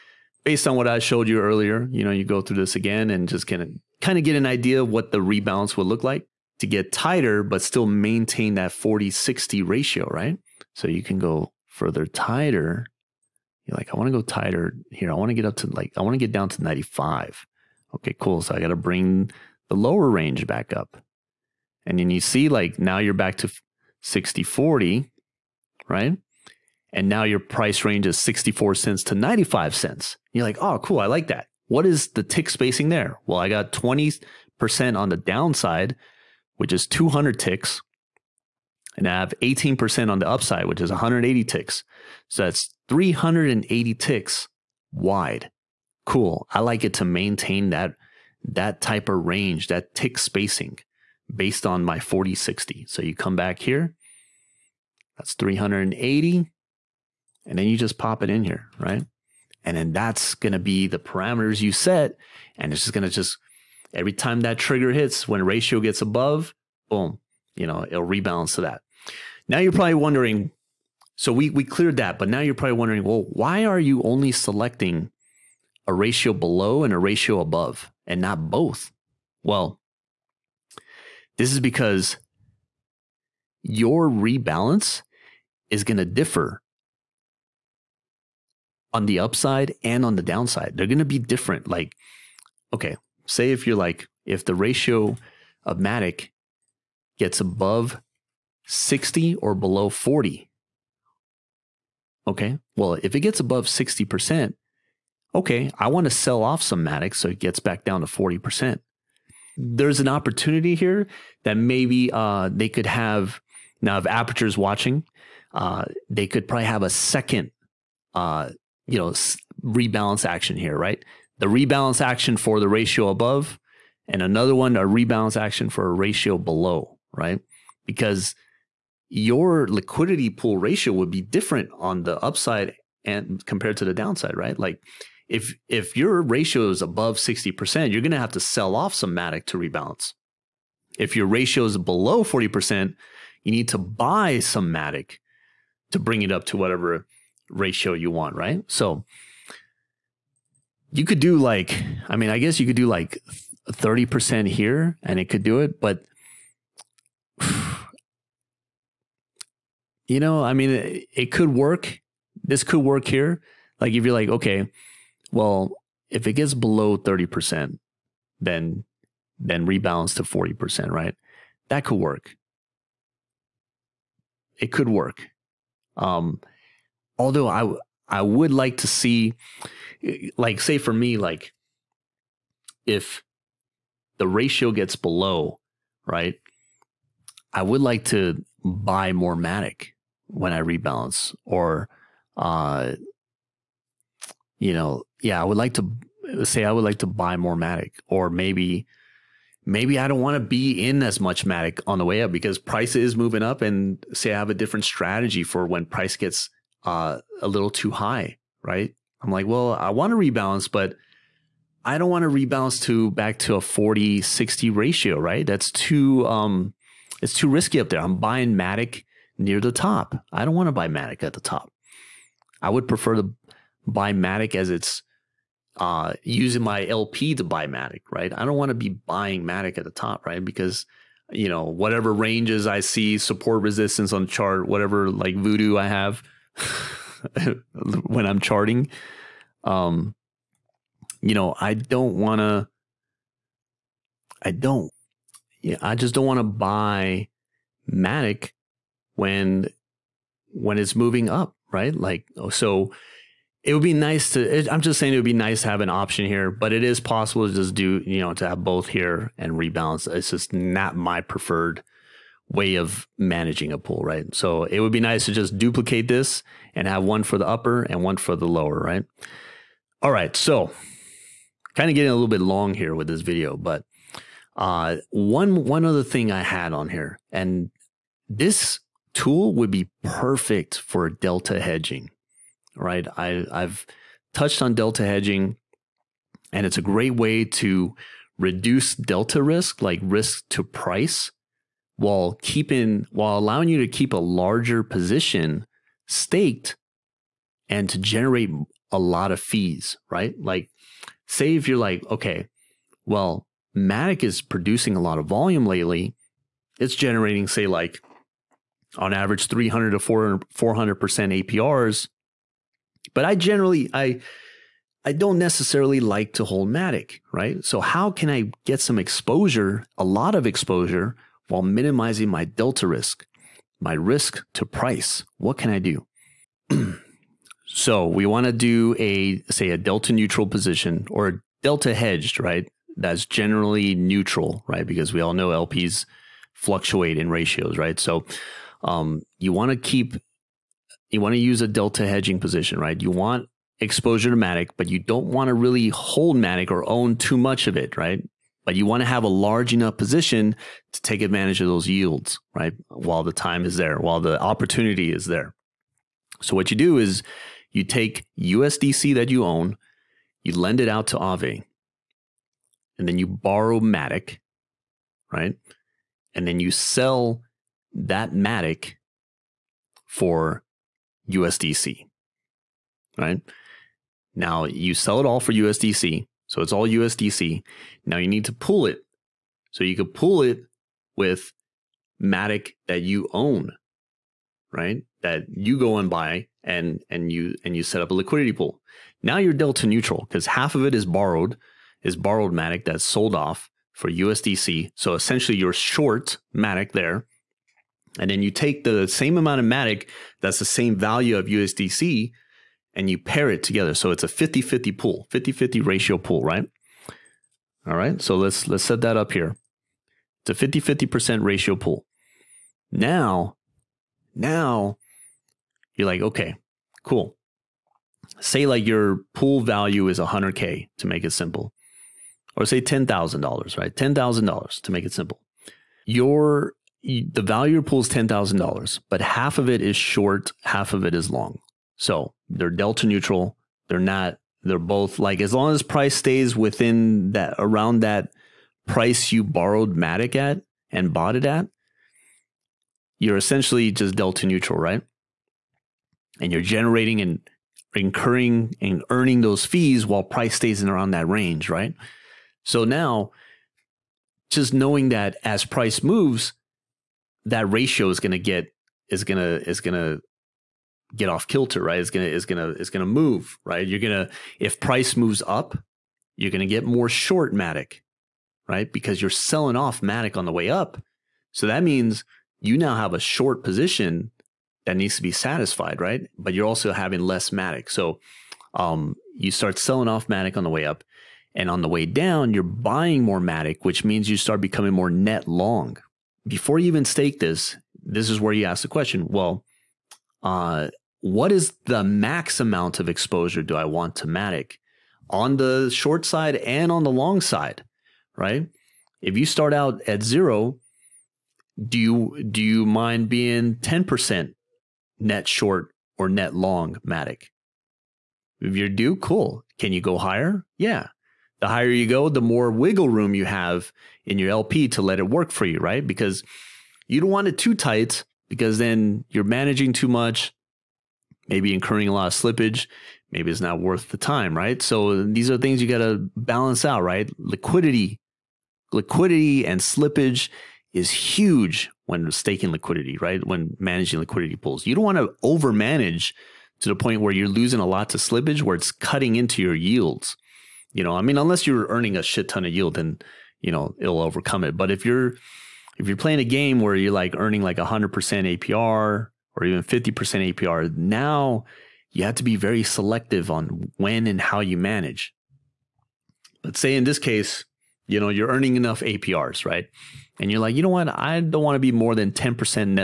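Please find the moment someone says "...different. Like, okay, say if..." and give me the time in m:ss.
1:31.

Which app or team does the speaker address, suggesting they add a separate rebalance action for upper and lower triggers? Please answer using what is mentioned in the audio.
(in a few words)
Aperture.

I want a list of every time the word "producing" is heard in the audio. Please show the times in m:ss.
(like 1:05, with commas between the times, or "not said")
5:04.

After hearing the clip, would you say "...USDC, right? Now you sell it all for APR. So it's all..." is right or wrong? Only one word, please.
wrong.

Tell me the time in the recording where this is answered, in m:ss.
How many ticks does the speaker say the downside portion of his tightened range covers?
0:36.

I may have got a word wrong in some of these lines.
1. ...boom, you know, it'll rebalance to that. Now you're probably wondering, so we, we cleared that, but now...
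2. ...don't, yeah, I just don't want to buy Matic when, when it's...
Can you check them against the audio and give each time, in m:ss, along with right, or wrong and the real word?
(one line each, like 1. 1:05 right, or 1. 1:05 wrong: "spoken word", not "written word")
1. 1:06 right
2. 4:04 right.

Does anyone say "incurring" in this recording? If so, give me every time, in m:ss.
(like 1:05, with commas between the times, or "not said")
7:27, 8:41.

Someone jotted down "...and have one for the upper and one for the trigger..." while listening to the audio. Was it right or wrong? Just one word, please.
wrong.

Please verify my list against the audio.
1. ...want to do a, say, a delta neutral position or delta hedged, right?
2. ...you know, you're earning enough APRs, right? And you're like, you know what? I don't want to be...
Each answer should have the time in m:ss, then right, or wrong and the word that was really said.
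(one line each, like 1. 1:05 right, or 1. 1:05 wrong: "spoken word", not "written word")
1. 5:28 right
2. 9:18 right.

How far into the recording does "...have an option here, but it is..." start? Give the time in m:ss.
4:15.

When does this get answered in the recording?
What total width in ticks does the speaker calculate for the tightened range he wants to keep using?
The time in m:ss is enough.
0:42.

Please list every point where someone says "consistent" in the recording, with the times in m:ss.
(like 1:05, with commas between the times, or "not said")
not said.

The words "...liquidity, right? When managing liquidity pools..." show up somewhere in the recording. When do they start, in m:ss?
8:52.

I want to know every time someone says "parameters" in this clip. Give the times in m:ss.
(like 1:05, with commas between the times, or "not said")
1:00.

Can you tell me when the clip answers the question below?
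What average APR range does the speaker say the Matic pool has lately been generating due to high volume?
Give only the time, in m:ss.
5:09.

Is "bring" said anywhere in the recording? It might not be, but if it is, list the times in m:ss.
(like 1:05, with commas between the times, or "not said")
0:18, 2:25.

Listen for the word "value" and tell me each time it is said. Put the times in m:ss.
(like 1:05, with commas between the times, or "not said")
6:40, 6:59, 7:07.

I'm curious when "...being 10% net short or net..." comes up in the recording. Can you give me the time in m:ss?
8:23.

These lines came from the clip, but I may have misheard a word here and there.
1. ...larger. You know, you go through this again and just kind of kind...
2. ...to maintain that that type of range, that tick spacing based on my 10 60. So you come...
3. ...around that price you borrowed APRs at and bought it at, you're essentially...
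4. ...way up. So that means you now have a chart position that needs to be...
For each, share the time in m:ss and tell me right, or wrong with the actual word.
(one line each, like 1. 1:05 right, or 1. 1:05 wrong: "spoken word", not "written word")
1. 0:01 wrong: "earlier", not "larger"
2. 0:46 wrong: "40", not "10"
3. 7:17 wrong: "Matic", not "APRs"
4. 7:50 wrong: "short", not "chart".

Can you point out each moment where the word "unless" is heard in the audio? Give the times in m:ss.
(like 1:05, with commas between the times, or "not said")
9:01.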